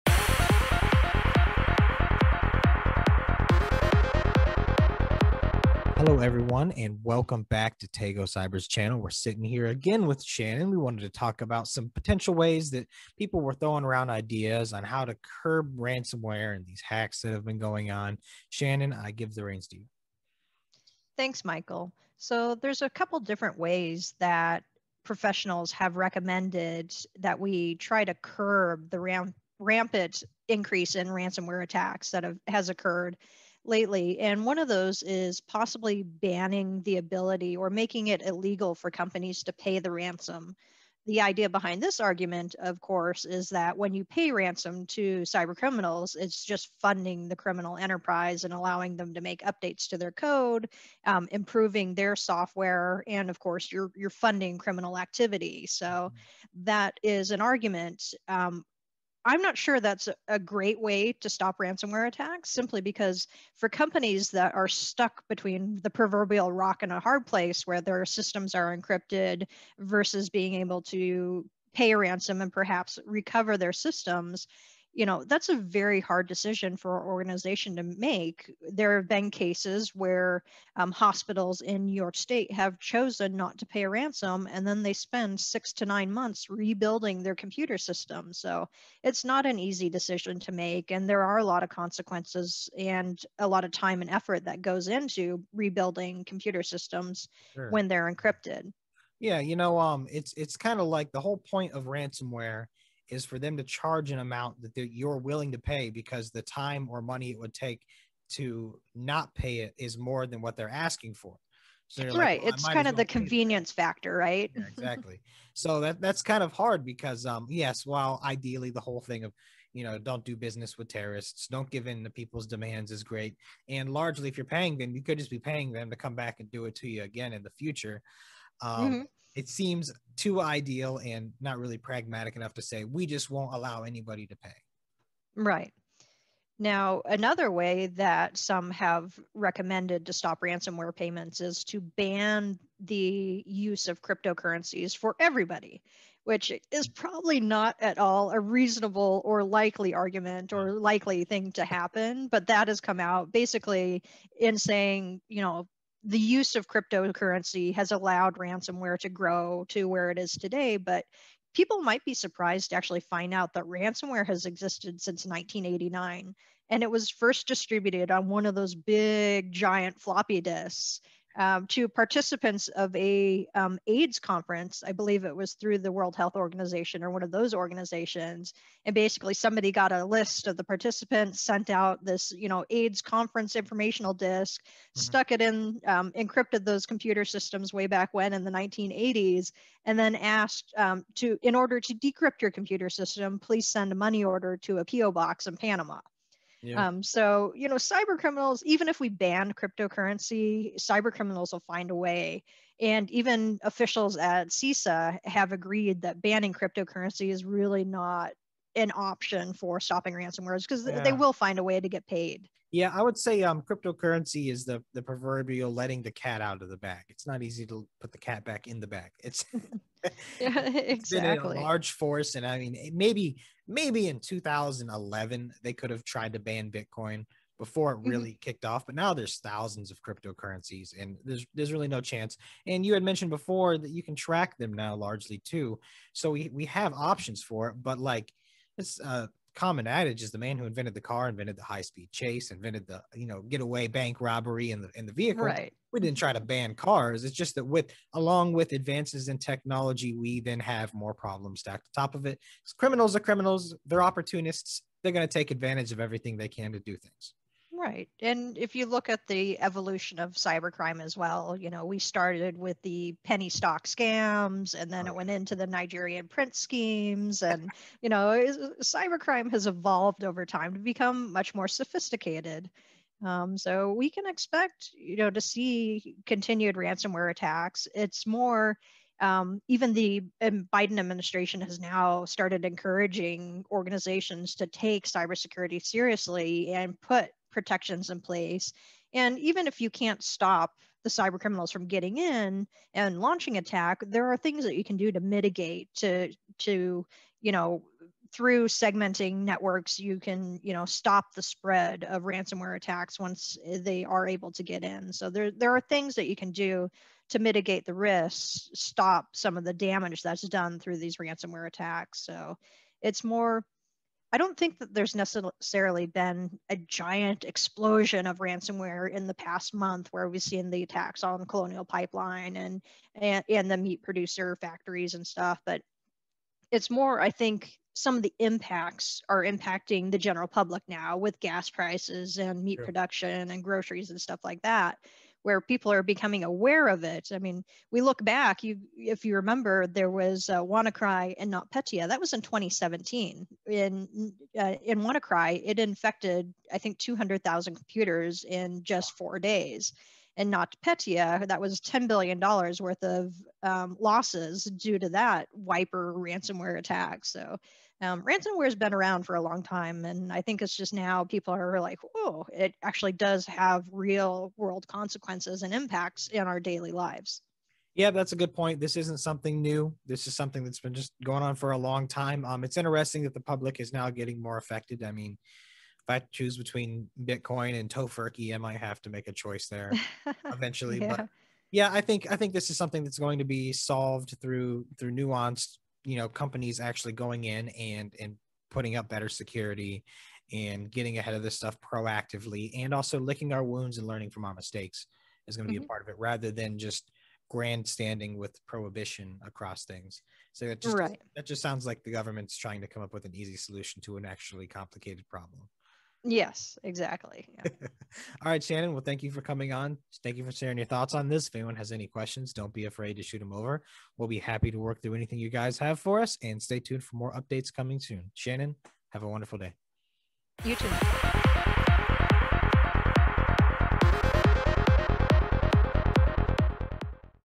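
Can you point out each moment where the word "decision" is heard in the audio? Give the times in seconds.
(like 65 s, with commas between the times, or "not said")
76 s, 89 s.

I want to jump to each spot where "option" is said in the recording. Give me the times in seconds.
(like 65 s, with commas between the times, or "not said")
208 s, 236 s.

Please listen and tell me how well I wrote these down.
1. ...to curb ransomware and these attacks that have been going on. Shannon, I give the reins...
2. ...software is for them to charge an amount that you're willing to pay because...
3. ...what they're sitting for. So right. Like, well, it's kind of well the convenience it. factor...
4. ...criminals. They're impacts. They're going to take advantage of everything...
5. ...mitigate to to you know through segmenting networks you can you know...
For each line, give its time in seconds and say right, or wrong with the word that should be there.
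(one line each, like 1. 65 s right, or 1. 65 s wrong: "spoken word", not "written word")
1. 15 s wrong: "hacks", not "attacks"
2. 101 s wrong: "ransomware", not "software"
3. 110 s wrong: "asking", not "sitting"
4. 253 s wrong: "opportunists", not "impacts"
5. 295 s right.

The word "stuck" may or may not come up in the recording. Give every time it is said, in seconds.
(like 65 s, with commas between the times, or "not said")
64 s, 184 s.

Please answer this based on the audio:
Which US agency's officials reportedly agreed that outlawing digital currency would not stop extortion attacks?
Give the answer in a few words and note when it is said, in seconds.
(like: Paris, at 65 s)
CISA, at 204 s.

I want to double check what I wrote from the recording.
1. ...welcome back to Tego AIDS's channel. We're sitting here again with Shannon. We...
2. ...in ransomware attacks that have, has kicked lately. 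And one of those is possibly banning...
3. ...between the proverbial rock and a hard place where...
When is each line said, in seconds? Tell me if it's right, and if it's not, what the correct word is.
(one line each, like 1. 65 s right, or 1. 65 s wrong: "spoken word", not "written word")
1. 7 s wrong: "Cyber", not "AIDS"
2. 30 s wrong: "occurred", not "kicked"
3. 65 s right.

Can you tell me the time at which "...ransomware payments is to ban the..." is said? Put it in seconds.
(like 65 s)
140 s.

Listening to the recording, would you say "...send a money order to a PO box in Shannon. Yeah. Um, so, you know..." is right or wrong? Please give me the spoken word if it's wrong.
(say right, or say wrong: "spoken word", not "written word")
wrong: "Panama", not "Shannon".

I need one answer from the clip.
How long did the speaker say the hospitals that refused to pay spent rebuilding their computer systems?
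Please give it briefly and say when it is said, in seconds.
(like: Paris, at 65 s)
6 to 9 months, at 85 s.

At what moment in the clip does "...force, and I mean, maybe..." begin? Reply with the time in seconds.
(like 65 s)
221 s.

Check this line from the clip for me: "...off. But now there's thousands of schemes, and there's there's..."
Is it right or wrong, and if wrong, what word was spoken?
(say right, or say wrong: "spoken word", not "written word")
wrong: "cryptocurrencies", not "schemes".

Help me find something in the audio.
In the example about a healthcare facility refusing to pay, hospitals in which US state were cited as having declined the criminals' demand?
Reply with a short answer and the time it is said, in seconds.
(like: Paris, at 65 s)
New York, at 81 s.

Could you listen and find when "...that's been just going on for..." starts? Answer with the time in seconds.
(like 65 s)
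370 s.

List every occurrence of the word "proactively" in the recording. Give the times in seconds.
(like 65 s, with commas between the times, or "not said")
391 s.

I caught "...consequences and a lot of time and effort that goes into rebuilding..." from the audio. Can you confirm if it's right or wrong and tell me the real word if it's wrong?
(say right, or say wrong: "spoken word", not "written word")
right.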